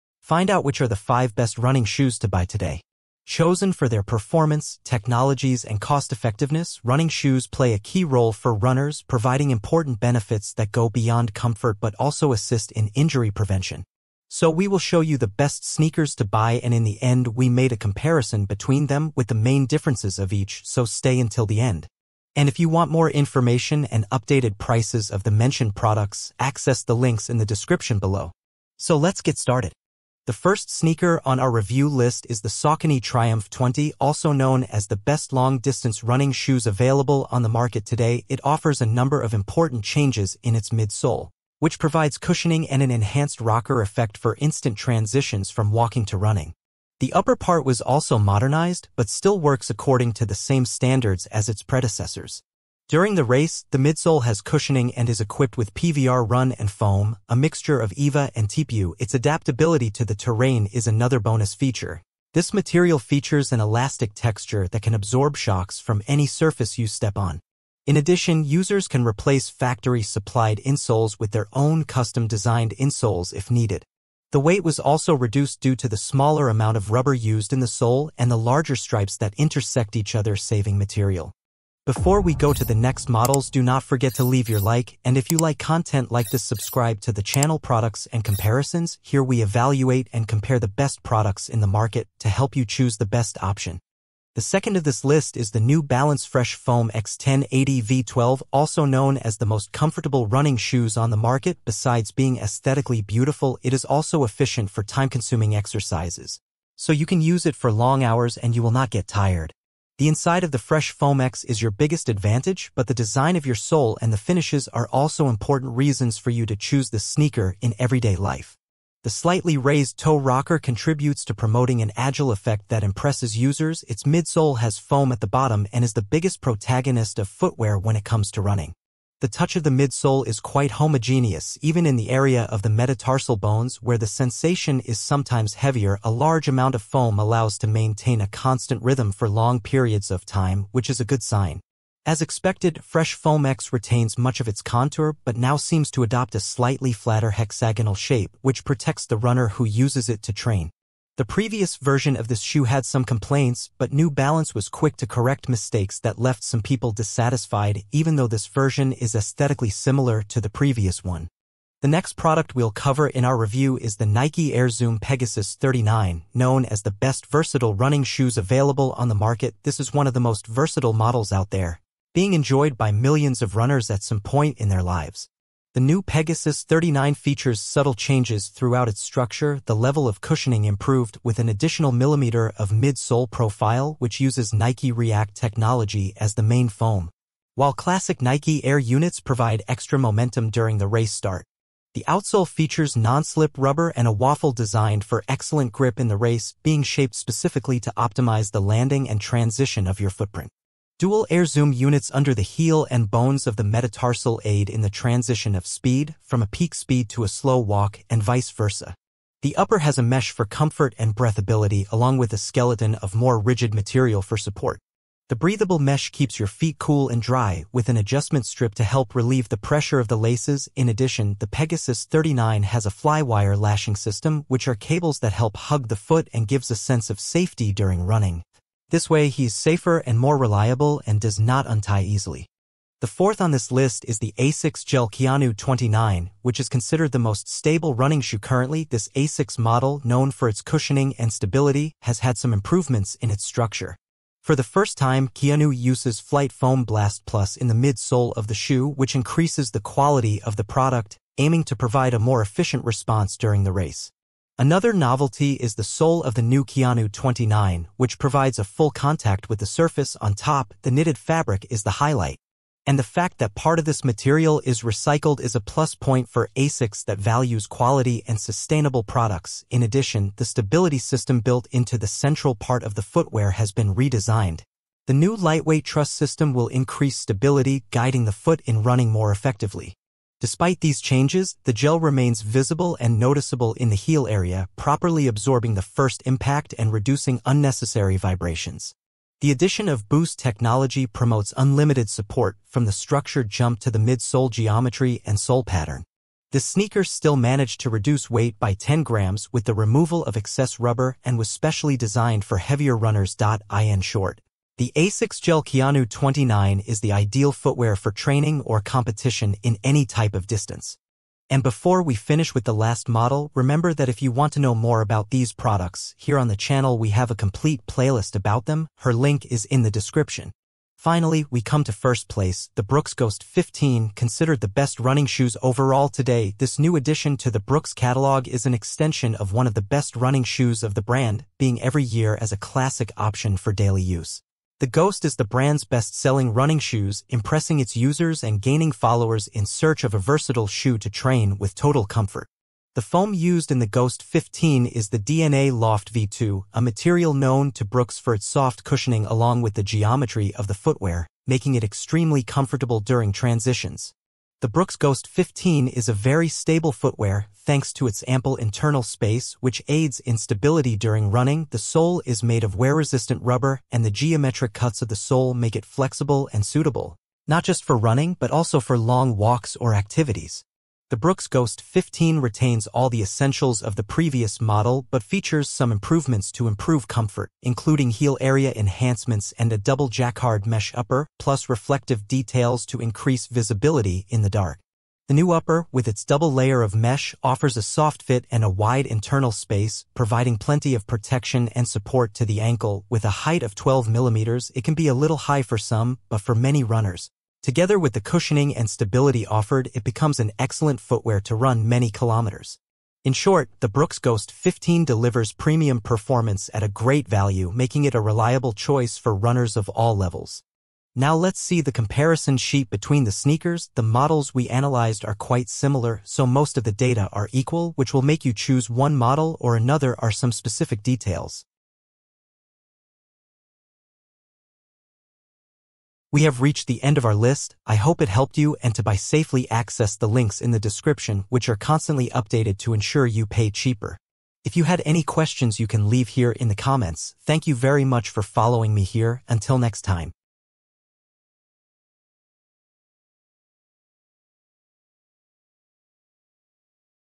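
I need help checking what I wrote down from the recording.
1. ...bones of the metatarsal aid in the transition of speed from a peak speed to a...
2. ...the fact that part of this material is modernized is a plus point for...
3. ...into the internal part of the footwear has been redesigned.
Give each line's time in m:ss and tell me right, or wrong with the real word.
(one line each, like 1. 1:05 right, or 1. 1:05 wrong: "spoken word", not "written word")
1. 3:23 right
2. 4:22 wrong: "recycled", not "modernized"
3. 4:31 wrong: "central", not "internal".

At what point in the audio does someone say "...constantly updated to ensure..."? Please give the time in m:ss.
7:11.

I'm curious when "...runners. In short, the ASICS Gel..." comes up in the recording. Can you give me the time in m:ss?
5:02.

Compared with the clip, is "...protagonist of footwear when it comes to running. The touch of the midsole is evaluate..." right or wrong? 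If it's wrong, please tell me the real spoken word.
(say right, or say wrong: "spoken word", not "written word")
wrong: "quite", not "evaluate".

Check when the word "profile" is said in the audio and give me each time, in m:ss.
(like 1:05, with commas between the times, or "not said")
3:03.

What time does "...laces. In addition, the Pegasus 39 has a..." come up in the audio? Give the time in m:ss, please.
3:40.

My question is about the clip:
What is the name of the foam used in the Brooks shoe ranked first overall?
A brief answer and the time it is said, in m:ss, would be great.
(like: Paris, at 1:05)
DNA Loft V2, at 5:45.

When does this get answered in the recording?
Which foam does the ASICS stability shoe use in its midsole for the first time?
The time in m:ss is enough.
4:06.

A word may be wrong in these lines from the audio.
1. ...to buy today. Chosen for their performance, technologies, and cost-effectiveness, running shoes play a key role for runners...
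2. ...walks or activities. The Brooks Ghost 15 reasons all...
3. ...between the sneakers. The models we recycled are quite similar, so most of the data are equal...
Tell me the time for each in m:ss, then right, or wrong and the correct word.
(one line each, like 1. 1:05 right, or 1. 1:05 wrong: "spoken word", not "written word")
1. 0:02 right
2. 6:09 wrong: "retains", not "reasons"
3. 6:52 wrong: "analyzed", not "recycled".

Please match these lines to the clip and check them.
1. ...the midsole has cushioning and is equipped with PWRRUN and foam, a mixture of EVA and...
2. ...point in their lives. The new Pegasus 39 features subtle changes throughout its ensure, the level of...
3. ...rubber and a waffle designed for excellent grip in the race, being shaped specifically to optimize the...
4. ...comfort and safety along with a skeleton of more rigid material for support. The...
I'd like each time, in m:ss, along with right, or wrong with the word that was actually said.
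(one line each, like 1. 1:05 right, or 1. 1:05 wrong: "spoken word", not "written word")
1. 0:53 right
2. 2:54 wrong: "structure", not "ensure"
3. 3:13 right
4. 3:30 wrong: "breathability", not "safety".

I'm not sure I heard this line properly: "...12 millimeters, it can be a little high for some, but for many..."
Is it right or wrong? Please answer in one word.
right.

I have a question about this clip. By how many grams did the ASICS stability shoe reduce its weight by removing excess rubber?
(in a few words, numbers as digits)
10.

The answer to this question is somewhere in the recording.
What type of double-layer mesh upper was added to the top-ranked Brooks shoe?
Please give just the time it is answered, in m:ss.
6:19.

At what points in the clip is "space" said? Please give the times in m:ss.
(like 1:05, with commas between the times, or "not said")
5:59, 6:29.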